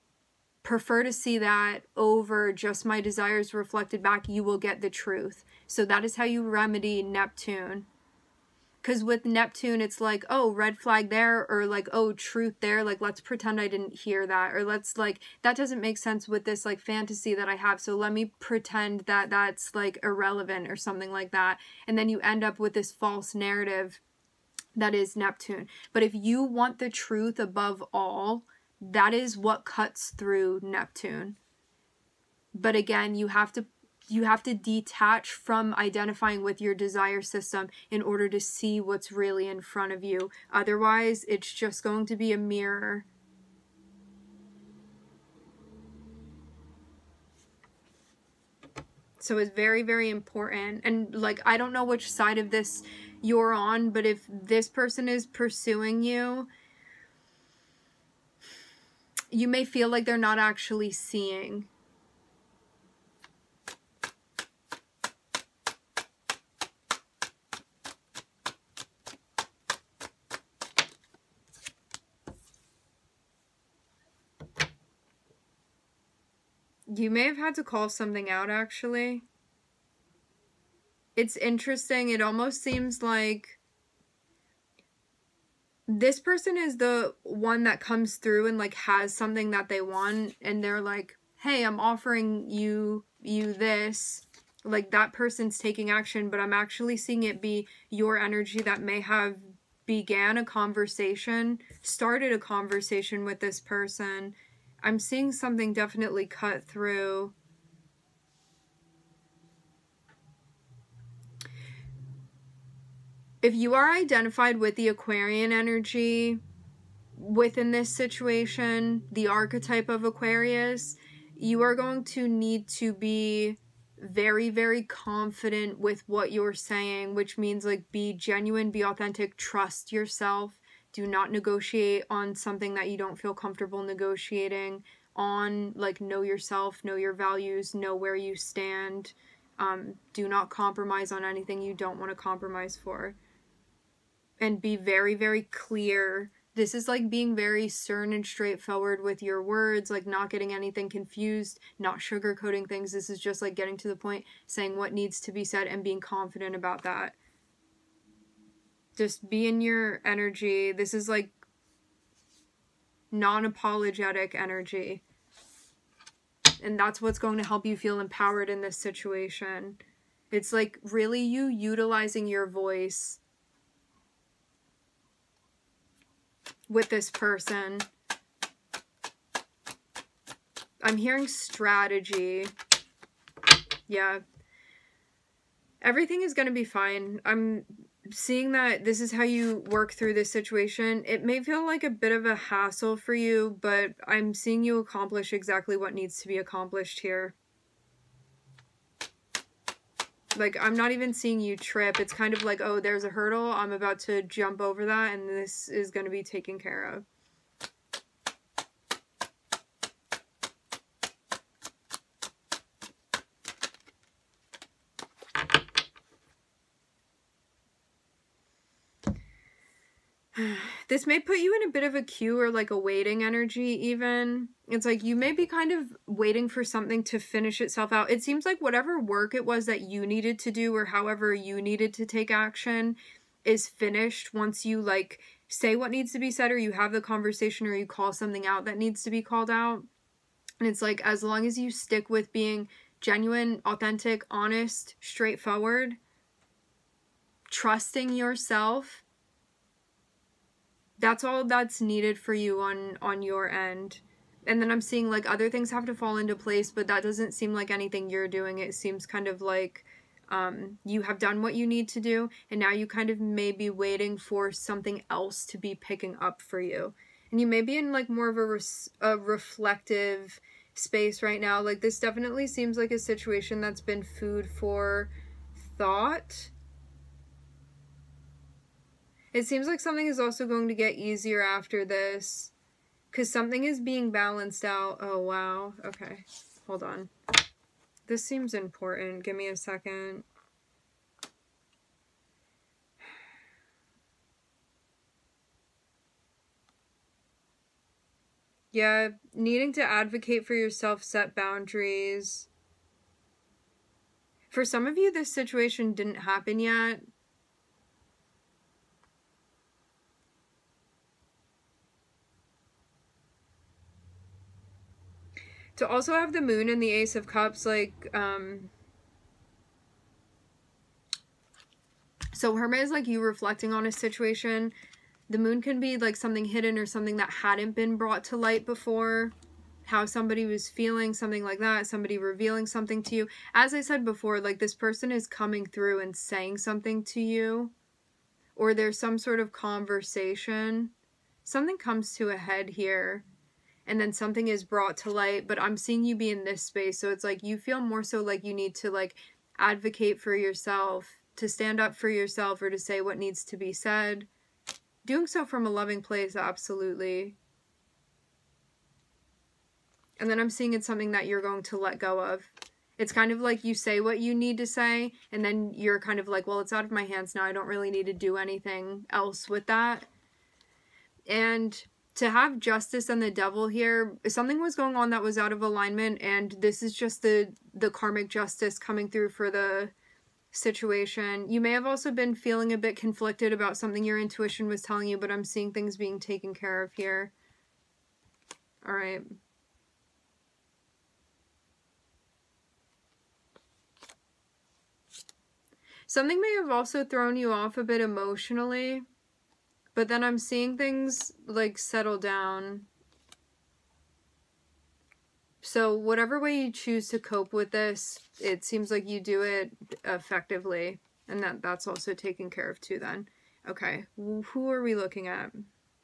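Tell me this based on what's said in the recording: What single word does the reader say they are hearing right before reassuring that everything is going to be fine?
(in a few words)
strategy.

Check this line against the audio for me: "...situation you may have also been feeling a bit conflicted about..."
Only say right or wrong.
right.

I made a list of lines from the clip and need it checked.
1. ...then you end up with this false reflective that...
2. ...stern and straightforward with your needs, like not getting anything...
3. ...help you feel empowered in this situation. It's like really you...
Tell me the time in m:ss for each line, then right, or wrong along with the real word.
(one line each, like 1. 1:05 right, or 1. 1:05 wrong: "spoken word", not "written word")
1. 0:21 wrong: "narrative", not "reflective"
2. 2:27 wrong: "words", not "needs"
3. 2:47 right.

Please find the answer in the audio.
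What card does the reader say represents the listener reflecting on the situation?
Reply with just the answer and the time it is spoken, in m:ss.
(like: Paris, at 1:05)
Hermit, at 5:22.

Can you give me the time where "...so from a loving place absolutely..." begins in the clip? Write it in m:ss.
5:55.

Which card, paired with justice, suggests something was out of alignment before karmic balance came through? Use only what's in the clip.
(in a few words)
the devil.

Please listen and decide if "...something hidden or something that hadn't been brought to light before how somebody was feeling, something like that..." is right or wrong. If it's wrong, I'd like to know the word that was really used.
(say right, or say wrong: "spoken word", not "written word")
right.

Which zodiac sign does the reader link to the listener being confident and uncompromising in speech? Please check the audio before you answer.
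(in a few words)
Aquarius.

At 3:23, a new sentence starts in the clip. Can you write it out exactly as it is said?
I'm about to jump over that, and this is going to be taken care of.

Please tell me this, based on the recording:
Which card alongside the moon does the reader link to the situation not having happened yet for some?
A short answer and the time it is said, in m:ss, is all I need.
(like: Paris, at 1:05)
ace of cups, at 5:16.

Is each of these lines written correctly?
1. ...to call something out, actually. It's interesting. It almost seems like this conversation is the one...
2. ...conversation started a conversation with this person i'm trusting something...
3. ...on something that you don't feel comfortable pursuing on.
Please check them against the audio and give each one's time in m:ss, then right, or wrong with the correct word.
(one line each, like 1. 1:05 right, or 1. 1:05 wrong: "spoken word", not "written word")
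1. 1:17 wrong: "person", not "conversation"
2. 1:40 wrong: "seeing", not "trusting"
3. 2:12 wrong: "negotiating", not "pursuing".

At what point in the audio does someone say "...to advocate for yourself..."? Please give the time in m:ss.
4:59.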